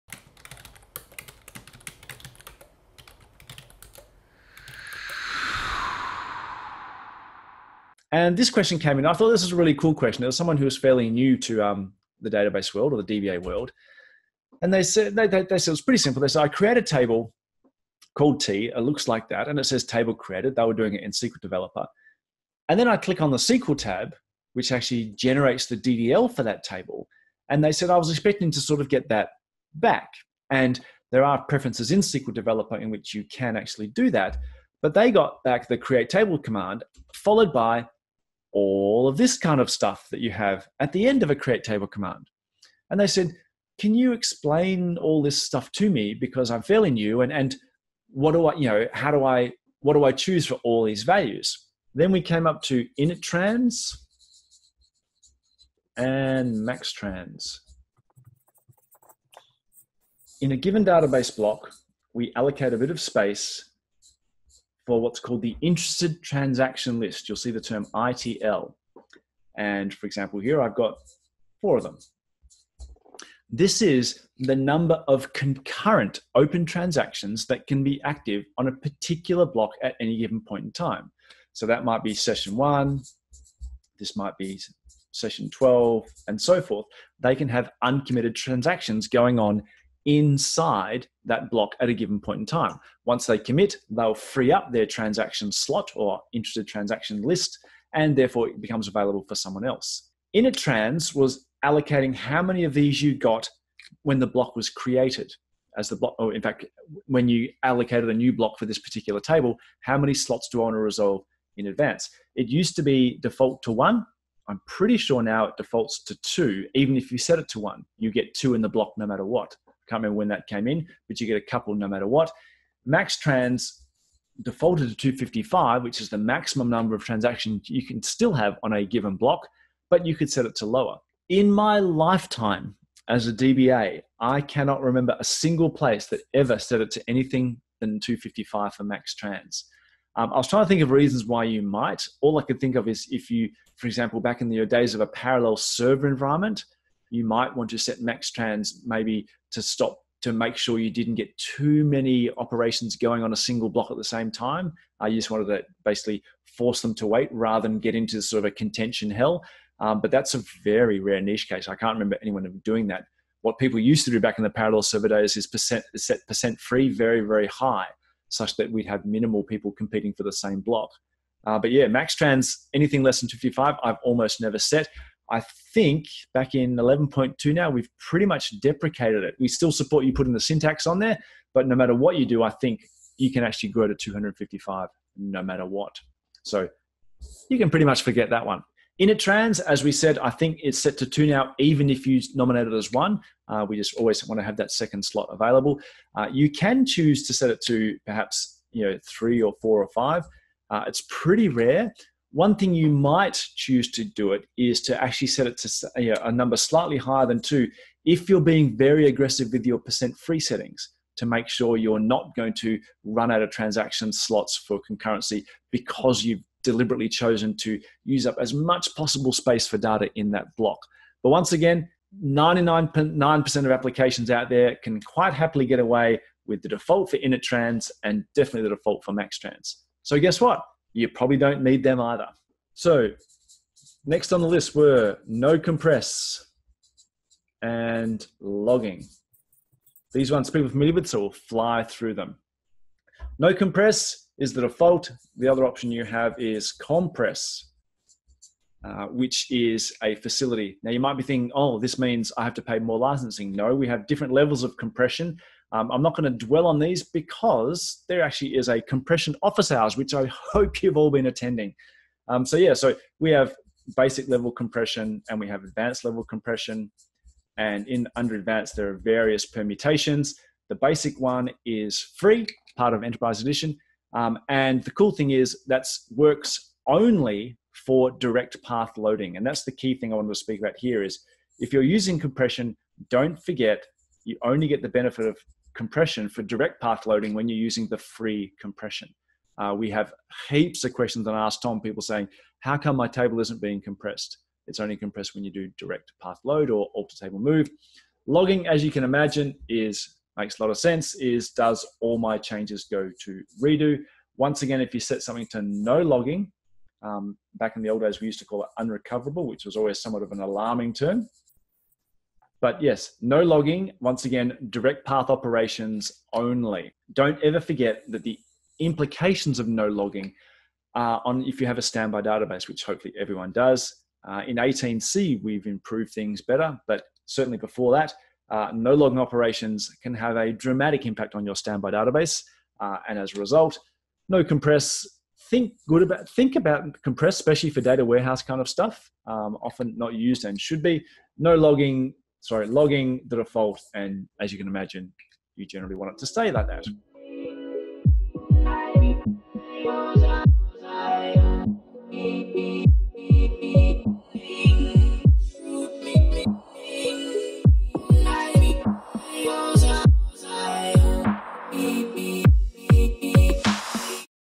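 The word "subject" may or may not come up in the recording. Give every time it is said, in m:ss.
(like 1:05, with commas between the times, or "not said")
not said.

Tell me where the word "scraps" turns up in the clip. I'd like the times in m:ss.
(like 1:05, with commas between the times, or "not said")
not said.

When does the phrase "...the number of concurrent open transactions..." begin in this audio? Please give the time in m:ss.
1:14.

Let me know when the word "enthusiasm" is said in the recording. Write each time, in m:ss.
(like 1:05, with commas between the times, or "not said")
not said.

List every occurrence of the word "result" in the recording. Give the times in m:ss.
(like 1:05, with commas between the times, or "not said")
5:33.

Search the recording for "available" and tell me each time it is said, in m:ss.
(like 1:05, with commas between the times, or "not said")
1:38, 3:15.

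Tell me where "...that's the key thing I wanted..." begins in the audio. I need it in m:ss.
4:39.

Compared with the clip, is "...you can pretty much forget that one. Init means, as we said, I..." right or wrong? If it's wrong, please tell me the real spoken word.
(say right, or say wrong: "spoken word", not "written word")
wrong: "trans", not "means".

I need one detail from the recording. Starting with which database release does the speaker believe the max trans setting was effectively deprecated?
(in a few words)
11.2.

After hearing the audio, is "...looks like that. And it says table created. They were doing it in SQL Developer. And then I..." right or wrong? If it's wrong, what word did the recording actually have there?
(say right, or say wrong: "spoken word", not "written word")
right.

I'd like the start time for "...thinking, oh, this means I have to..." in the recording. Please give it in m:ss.
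4:11.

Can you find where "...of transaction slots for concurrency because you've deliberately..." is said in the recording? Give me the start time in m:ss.
3:33.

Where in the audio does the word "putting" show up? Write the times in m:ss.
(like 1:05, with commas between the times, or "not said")
3:00.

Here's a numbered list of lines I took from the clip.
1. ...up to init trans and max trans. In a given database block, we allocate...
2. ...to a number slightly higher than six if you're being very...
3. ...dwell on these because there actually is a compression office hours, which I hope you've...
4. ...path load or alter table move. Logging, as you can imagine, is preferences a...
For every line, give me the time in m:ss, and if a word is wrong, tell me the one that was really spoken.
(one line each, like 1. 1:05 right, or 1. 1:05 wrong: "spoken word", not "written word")
1. 0:52 right
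2. 3:25 wrong: "two", not "six"
3. 4:16 right
4. 4:56 wrong: "makes", not "preferences".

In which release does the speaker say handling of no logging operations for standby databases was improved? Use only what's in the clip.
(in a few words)
18C.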